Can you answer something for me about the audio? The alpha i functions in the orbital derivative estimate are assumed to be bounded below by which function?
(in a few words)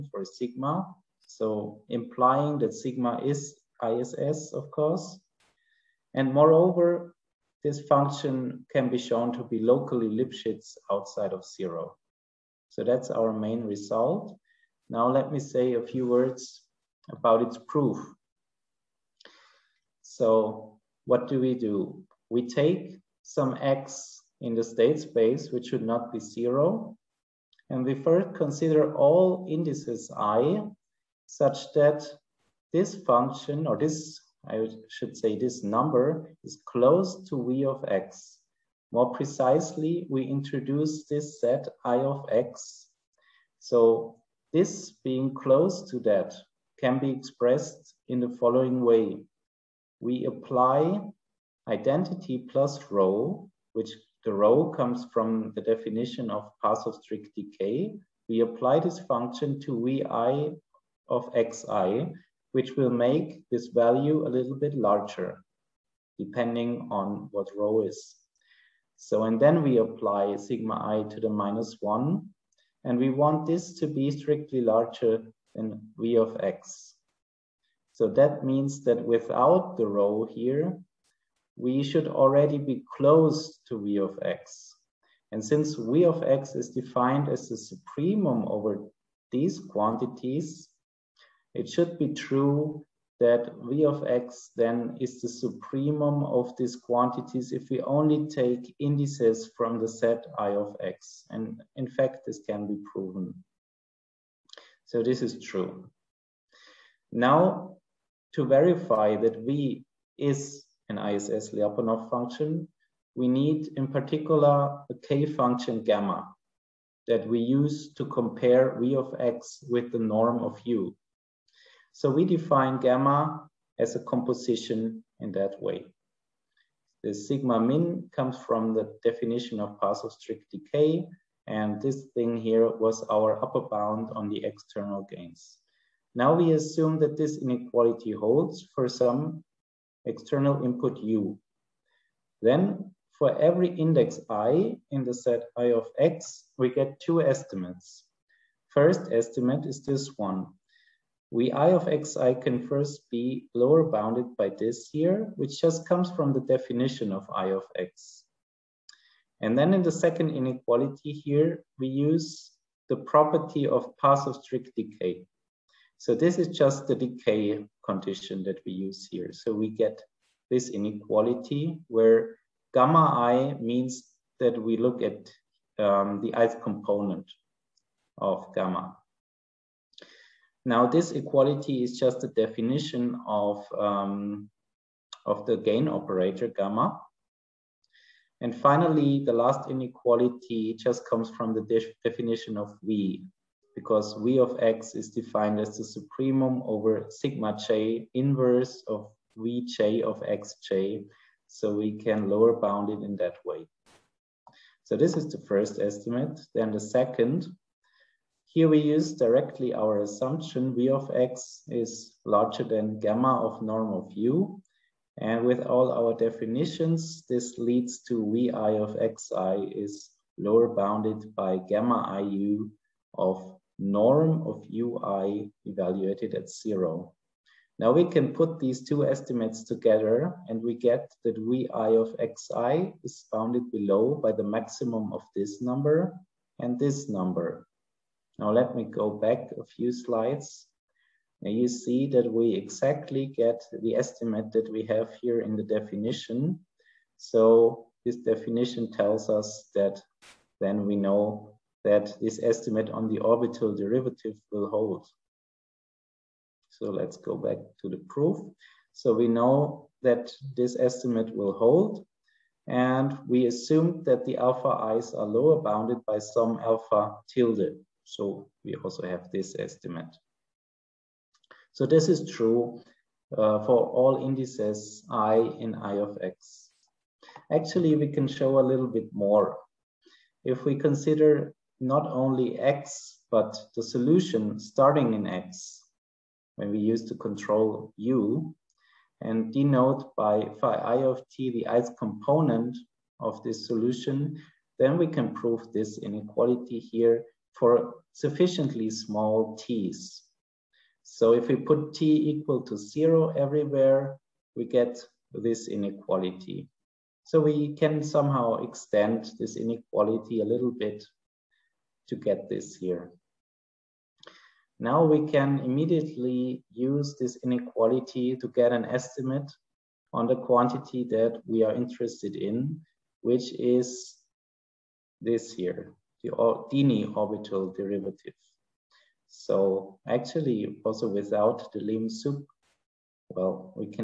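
alpha tilde.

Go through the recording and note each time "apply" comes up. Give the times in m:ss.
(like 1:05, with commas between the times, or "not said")
0:50, 0:58, 1:09.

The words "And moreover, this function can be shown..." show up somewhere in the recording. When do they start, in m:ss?
0:06.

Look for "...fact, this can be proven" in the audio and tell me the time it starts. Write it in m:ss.
1:41.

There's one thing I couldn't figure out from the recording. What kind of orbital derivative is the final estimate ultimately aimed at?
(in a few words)
Dini orbital derivative.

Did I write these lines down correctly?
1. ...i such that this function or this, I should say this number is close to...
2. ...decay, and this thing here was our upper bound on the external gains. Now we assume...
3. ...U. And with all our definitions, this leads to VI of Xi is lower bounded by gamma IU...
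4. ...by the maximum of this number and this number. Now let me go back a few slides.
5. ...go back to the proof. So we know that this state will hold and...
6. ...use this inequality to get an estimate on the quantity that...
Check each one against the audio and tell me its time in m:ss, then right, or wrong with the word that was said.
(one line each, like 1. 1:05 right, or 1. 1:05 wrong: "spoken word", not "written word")
1. 0:30 right
2. 2:10 right
3. 3:34 right
4. 3:54 right
5. 4:17 wrong: "estimate", not "state"
6. 5:16 right.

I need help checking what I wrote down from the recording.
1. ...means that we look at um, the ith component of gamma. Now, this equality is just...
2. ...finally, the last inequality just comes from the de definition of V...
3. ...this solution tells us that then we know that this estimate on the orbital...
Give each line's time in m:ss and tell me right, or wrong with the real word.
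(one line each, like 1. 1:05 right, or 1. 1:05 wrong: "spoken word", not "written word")
1. 2:53 right
2. 3:08 right
3. 4:08 wrong: "definition", not "solution".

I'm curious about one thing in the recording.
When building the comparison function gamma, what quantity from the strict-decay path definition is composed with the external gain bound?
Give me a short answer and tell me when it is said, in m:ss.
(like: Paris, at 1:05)
sigma min, at 2:07.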